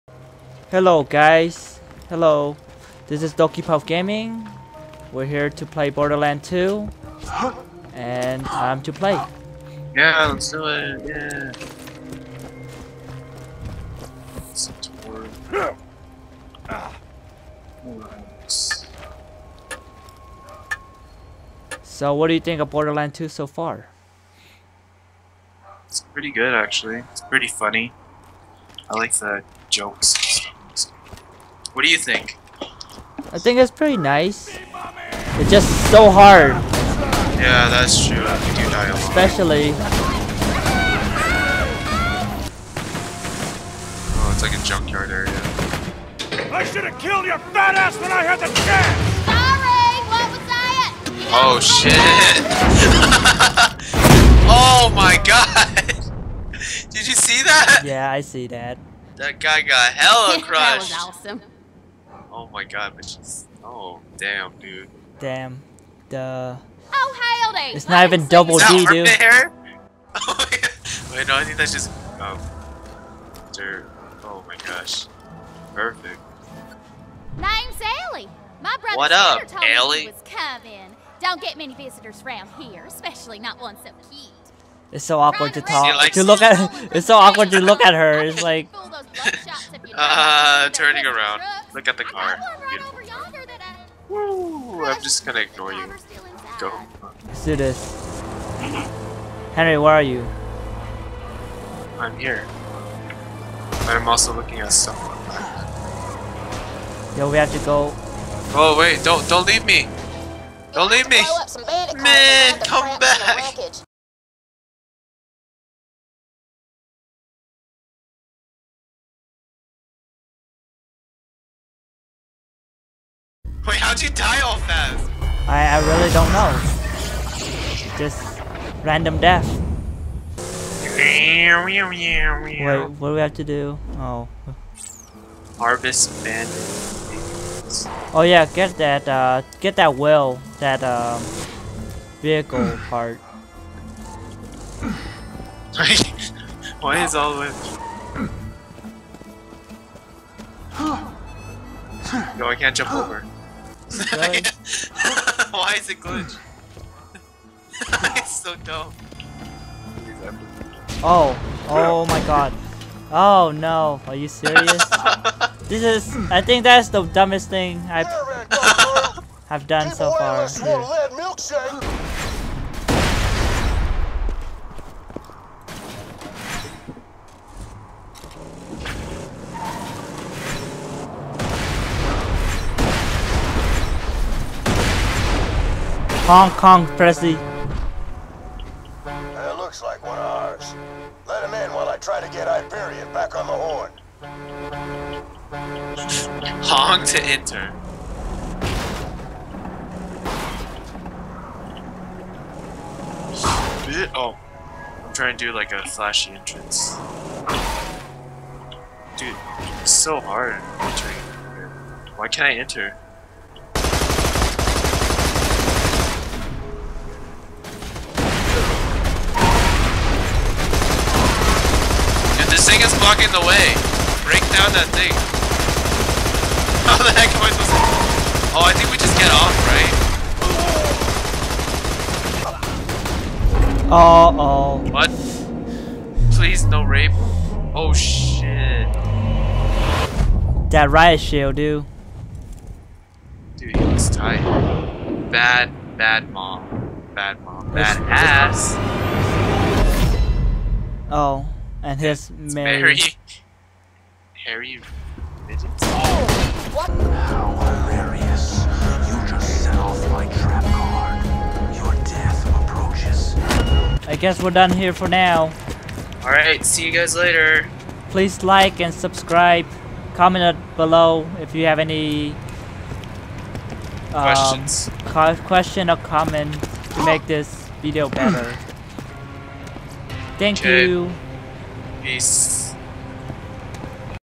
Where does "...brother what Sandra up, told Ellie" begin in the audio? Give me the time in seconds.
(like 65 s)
78 s.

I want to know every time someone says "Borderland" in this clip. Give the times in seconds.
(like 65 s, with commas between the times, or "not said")
5 s, 22 s.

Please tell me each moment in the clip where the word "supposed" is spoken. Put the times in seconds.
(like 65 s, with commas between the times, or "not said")
227 s.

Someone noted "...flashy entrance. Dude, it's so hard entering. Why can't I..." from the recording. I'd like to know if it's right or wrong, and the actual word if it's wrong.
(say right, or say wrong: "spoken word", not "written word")
right.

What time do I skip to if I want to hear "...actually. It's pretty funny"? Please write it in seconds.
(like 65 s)
26 s.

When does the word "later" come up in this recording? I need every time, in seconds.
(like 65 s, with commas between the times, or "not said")
267 s.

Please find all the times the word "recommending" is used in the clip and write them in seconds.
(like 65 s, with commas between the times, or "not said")
not said.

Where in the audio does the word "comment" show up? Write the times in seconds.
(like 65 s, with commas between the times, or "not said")
270 s, 275 s.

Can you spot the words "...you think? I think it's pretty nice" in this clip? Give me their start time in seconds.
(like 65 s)
31 s.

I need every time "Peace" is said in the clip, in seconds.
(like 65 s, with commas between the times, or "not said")
282 s.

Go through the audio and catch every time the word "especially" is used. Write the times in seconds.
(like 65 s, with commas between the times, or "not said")
38 s, 82 s.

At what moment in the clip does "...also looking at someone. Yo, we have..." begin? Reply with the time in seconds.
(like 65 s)
104 s.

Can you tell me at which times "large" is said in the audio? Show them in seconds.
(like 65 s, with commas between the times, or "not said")
not said.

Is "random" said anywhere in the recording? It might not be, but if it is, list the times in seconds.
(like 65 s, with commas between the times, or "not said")
128 s.